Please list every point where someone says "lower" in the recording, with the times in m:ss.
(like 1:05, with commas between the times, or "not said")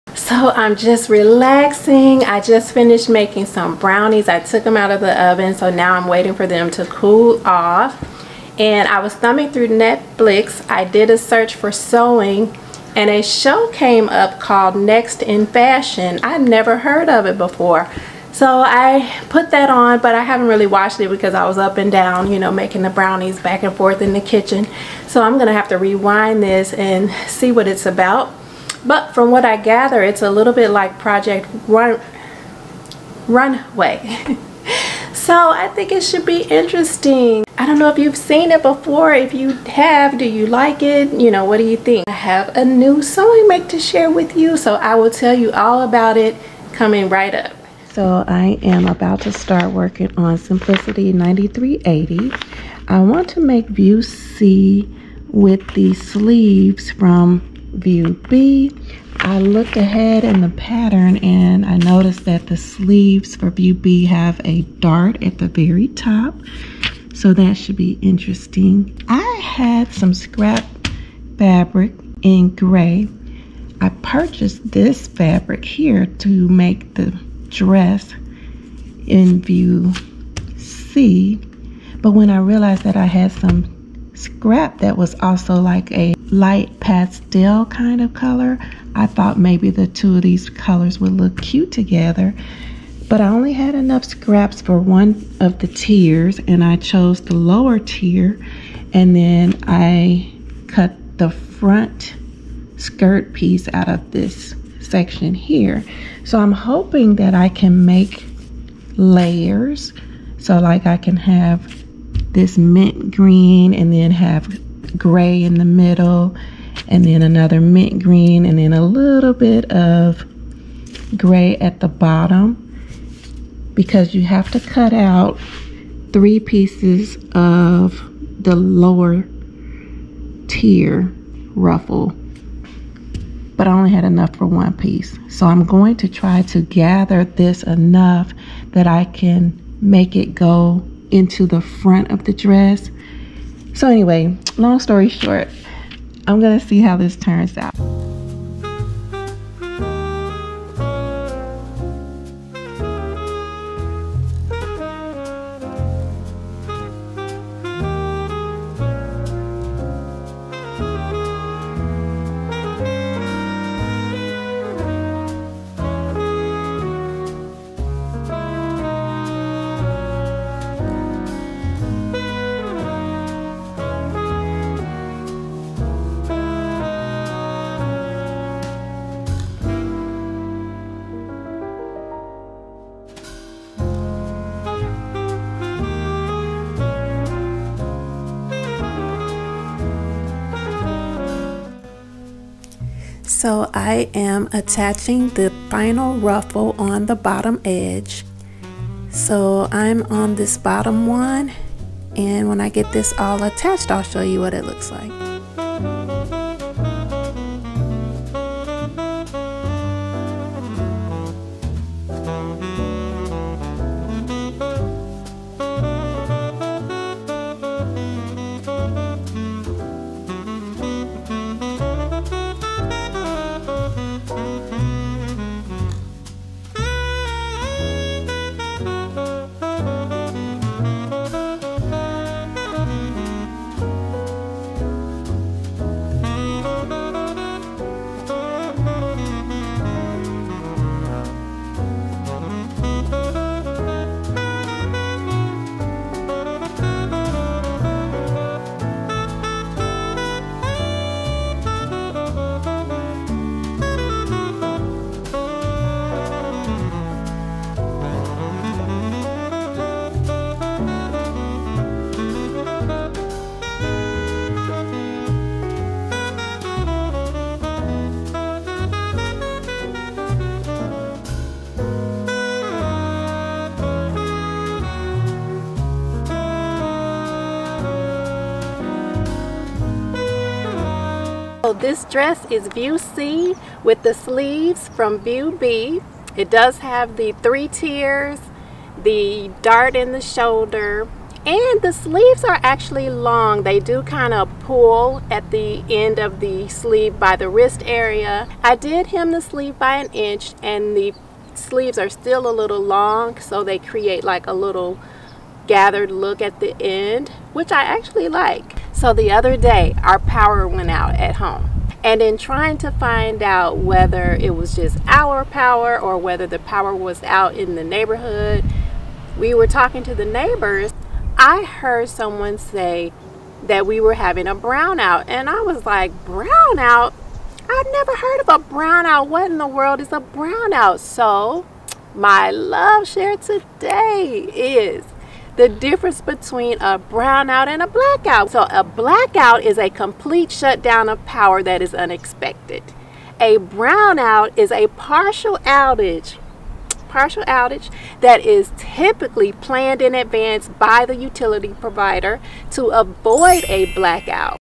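1:37, 2:08.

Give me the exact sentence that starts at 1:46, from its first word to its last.
So I'm hoping that I can make layers.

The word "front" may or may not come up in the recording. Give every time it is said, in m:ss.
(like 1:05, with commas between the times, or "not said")
1:41, 2:21.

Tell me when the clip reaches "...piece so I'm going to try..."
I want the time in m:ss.
2:14.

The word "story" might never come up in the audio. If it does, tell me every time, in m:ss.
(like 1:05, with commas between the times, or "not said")
2:24.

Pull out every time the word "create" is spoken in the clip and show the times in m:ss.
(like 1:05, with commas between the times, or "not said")
5:03.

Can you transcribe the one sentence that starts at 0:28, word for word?
But from what I gather, it's a little bit like Project Run Runway.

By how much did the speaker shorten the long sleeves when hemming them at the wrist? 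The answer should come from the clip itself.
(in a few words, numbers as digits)
an inch.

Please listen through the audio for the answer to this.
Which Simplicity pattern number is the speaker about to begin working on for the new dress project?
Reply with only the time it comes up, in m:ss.
0:50.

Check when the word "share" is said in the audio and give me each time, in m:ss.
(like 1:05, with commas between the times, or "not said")
0:43, 5:33.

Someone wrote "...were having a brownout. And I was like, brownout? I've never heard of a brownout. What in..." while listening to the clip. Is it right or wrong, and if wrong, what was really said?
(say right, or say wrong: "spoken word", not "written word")
right.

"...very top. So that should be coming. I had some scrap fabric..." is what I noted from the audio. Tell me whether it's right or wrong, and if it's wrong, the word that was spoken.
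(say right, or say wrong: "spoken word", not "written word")
wrong: "interesting", not "coming".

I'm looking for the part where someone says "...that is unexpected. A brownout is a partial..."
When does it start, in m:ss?
5:41.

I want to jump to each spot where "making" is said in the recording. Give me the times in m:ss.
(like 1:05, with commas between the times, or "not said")
0:03, 0:22.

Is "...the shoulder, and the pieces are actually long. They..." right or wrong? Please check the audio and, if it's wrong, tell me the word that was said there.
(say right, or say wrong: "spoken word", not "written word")
wrong: "sleeves", not "pieces".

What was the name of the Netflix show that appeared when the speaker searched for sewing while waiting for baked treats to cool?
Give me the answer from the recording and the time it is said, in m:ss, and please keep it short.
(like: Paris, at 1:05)
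Next in Fashion, at 0:14.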